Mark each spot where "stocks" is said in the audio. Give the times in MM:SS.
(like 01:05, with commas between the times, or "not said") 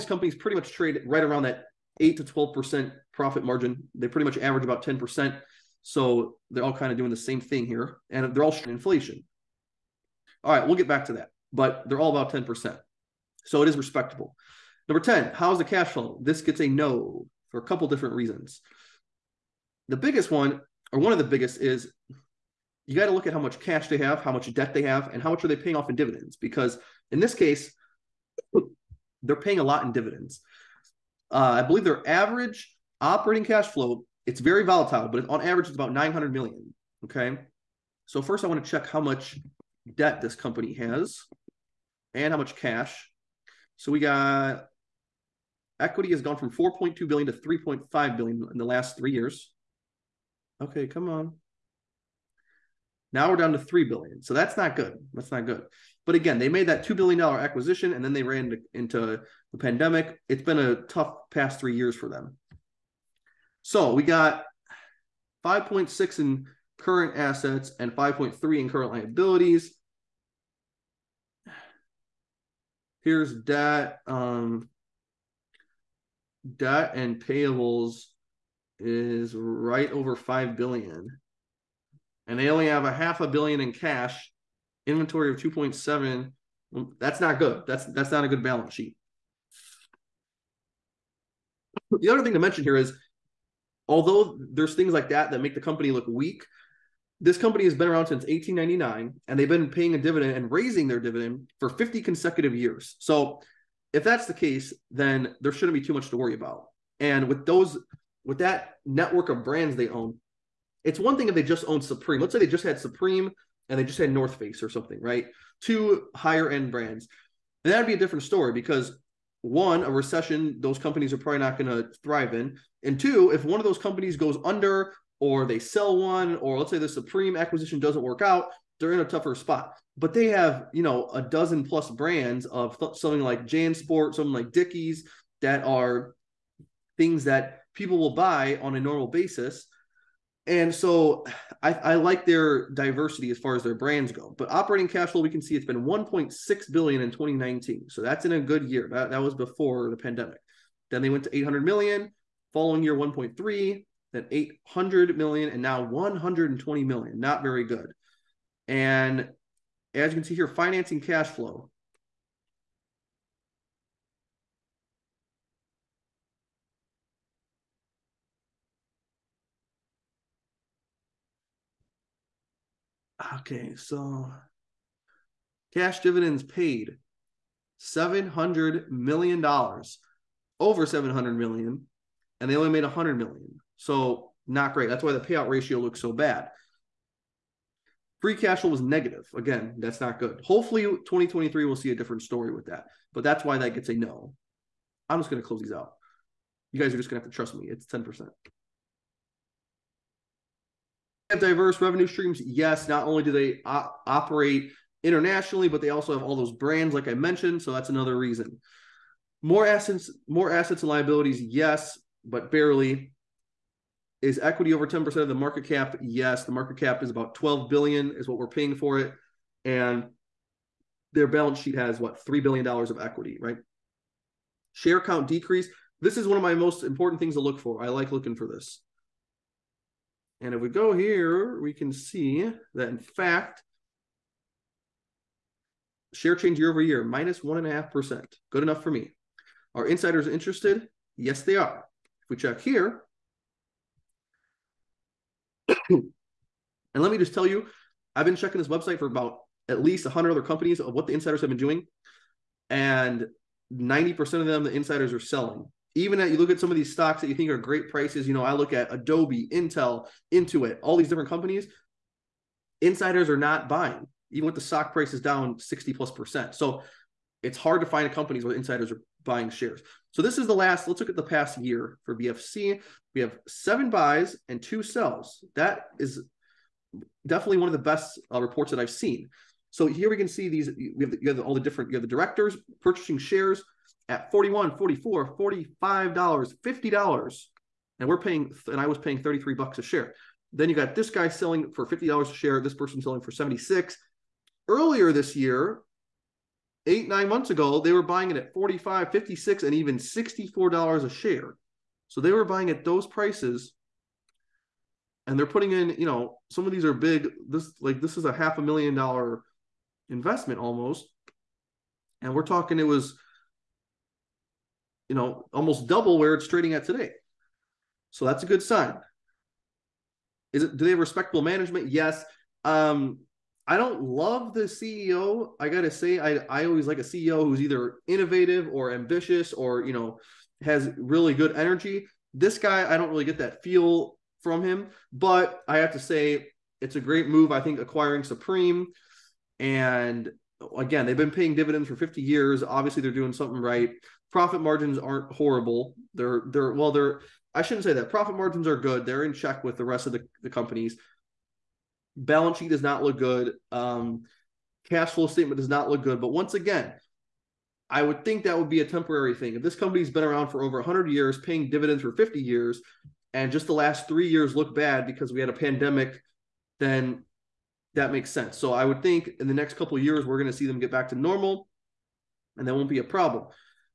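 04:16, 04:24.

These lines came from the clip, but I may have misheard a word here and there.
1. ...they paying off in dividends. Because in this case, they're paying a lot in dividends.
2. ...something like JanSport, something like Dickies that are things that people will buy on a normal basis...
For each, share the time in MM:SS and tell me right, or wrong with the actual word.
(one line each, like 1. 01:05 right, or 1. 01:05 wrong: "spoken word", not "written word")
1. 00:25 right
2. 02:12 right.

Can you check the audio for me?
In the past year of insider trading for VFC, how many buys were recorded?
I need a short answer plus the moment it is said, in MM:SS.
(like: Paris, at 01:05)
7, at 04:33.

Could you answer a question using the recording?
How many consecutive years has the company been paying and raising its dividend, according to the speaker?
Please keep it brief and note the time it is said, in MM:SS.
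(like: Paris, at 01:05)
50, at 01:41.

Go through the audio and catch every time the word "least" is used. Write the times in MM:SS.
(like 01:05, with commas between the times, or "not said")
04:09.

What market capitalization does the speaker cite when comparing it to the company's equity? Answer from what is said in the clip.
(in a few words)
12 billion.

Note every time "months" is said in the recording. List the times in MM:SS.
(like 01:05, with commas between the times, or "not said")
04:57.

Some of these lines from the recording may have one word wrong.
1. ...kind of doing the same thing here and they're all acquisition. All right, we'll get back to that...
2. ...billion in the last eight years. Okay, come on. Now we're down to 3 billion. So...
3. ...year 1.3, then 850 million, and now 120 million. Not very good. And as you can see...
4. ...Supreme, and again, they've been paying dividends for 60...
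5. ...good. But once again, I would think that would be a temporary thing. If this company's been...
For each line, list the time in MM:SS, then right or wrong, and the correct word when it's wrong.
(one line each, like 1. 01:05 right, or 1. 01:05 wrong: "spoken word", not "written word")
1. 00:06 wrong: "inflation", not "acquisition"
2. 00:48 wrong: "three", not "eight"
3. 02:32 wrong: "800", not "850"
4. 05:38 wrong: "50", not "60"
5. 05:56 right.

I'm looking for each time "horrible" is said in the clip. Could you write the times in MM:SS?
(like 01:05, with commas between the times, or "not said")
05:45.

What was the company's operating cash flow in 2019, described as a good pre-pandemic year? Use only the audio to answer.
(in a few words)
1.6 billion.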